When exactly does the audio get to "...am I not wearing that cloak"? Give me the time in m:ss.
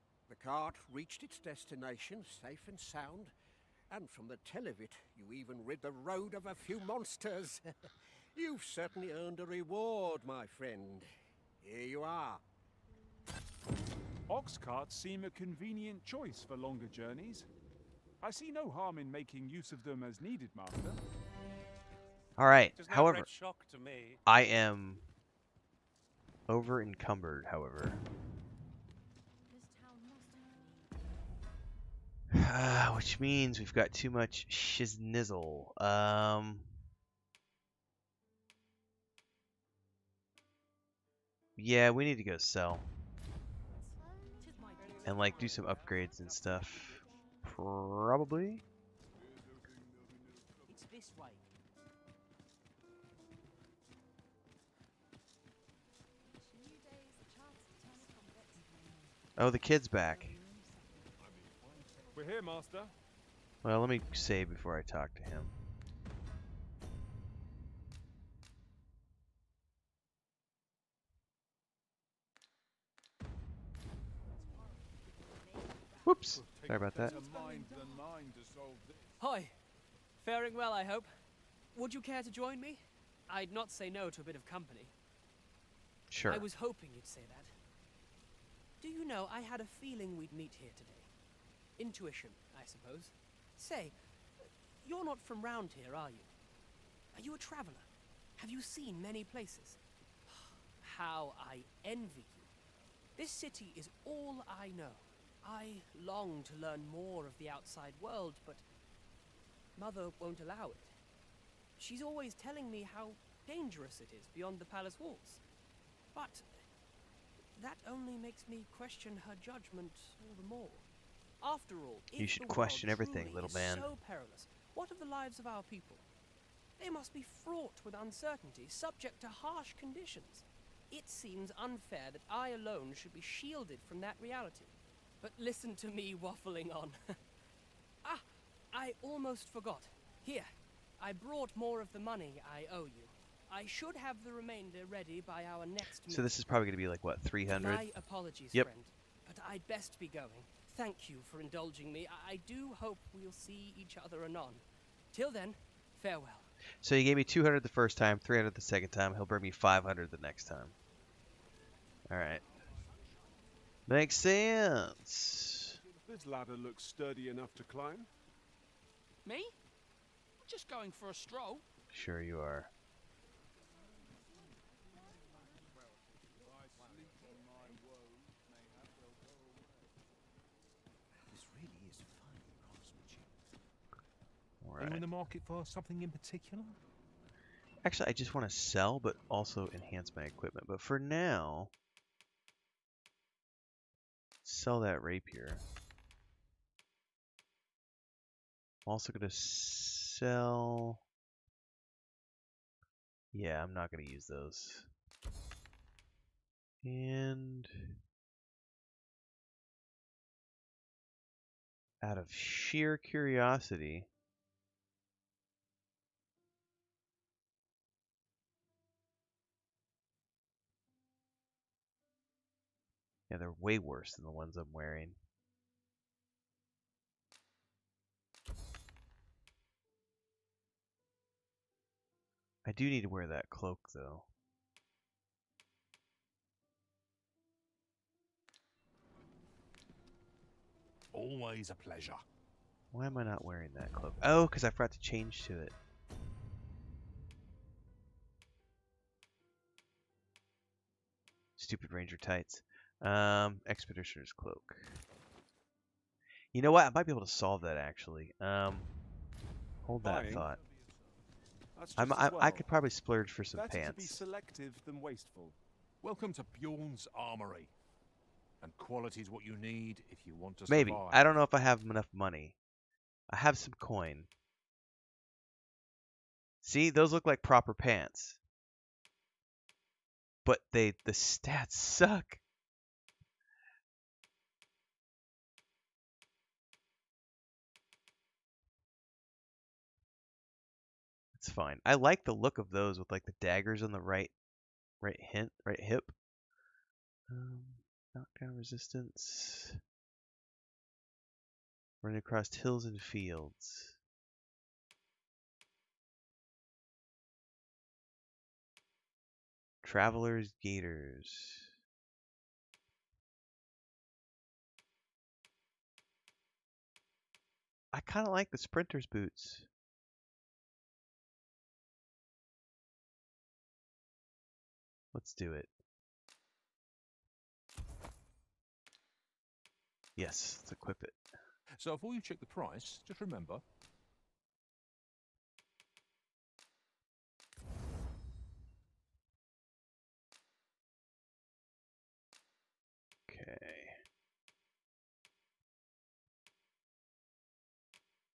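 4:03.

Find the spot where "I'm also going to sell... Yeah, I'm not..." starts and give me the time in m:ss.
3:18.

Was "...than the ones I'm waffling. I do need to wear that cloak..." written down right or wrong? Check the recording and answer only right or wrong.
wrong.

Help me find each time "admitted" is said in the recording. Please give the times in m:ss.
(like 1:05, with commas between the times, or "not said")
not said.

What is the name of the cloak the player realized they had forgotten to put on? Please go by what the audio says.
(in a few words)
Expeditioner's Cloak.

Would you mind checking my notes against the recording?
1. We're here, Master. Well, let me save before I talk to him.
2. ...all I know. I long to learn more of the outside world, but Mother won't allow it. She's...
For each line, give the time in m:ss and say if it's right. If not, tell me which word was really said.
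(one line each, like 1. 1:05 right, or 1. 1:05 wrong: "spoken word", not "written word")
1. 1:02 right
2. 1:44 right.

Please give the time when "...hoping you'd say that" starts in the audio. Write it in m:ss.
1:26.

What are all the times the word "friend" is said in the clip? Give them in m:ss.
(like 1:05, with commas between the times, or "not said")
0:10, 2:28.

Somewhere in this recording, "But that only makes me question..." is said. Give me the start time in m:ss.
1:56.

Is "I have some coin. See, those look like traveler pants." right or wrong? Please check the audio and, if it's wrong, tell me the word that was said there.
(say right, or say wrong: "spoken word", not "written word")
wrong: "proper", not "traveler".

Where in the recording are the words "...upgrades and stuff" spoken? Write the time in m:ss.
0:45.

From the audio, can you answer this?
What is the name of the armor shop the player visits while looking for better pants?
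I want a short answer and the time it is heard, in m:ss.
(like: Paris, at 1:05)
Bjorn's Armory, at 4:26.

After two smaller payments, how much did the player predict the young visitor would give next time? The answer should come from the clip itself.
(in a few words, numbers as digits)
500.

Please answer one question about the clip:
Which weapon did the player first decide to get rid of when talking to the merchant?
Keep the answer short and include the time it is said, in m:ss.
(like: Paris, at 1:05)
rapier, at 3:14.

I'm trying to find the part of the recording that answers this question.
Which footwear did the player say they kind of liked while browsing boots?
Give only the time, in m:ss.
5:18.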